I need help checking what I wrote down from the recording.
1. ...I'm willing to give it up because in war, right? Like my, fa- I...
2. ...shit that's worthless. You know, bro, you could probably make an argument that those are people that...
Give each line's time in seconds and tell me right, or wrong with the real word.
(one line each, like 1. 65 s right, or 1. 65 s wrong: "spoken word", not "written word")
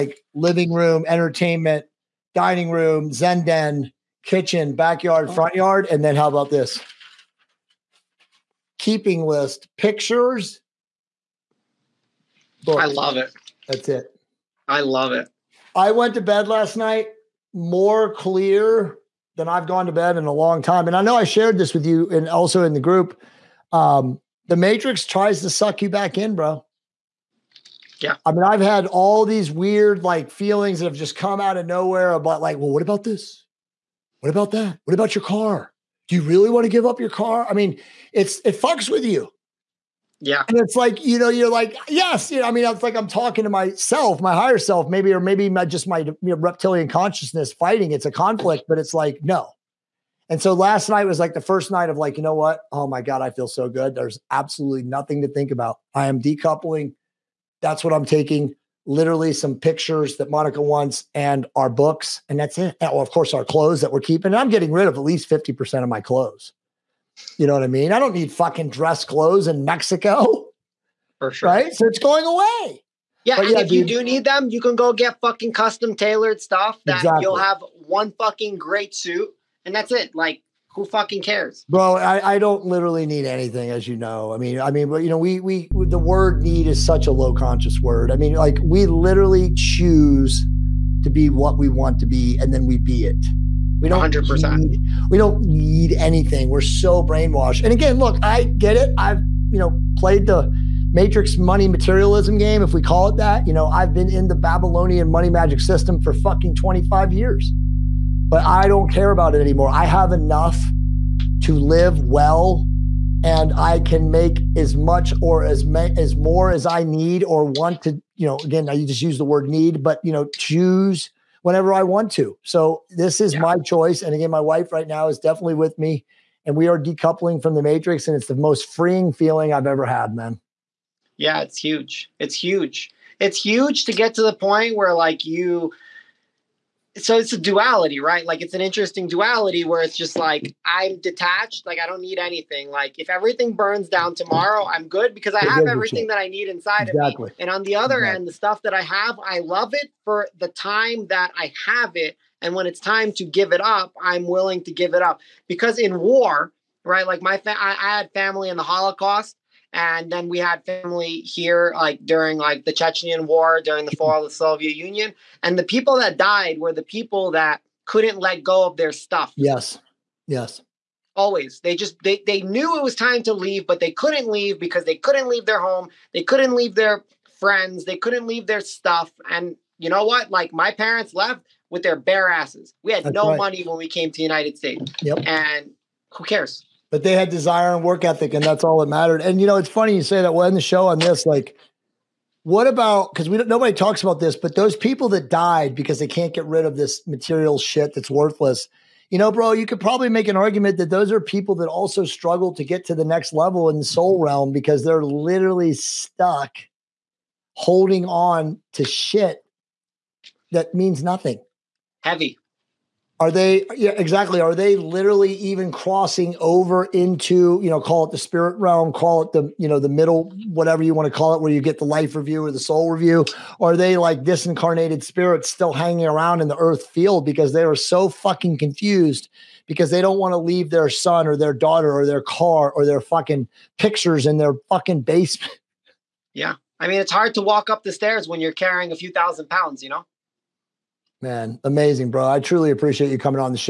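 1. 154 s right
2. 197 s right.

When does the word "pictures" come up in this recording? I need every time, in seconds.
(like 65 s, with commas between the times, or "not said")
9 s, 59 s, 233 s.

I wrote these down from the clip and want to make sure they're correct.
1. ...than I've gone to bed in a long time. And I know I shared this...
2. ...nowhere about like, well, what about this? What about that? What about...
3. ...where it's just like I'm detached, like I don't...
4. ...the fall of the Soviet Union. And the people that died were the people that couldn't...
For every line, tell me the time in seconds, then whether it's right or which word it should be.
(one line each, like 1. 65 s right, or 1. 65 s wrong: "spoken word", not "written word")
1. 19 s right
2. 31 s right
3. 139 s right
4. 163 s right.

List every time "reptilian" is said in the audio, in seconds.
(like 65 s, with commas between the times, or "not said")
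46 s.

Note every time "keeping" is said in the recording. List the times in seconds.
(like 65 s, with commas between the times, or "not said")
8 s, 63 s.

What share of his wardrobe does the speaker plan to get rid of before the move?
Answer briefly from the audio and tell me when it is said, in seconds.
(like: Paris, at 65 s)
50%, at 65 s.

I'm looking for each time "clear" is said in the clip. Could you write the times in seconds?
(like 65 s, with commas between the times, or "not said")
18 s.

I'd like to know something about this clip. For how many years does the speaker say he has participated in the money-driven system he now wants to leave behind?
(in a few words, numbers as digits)
25 years.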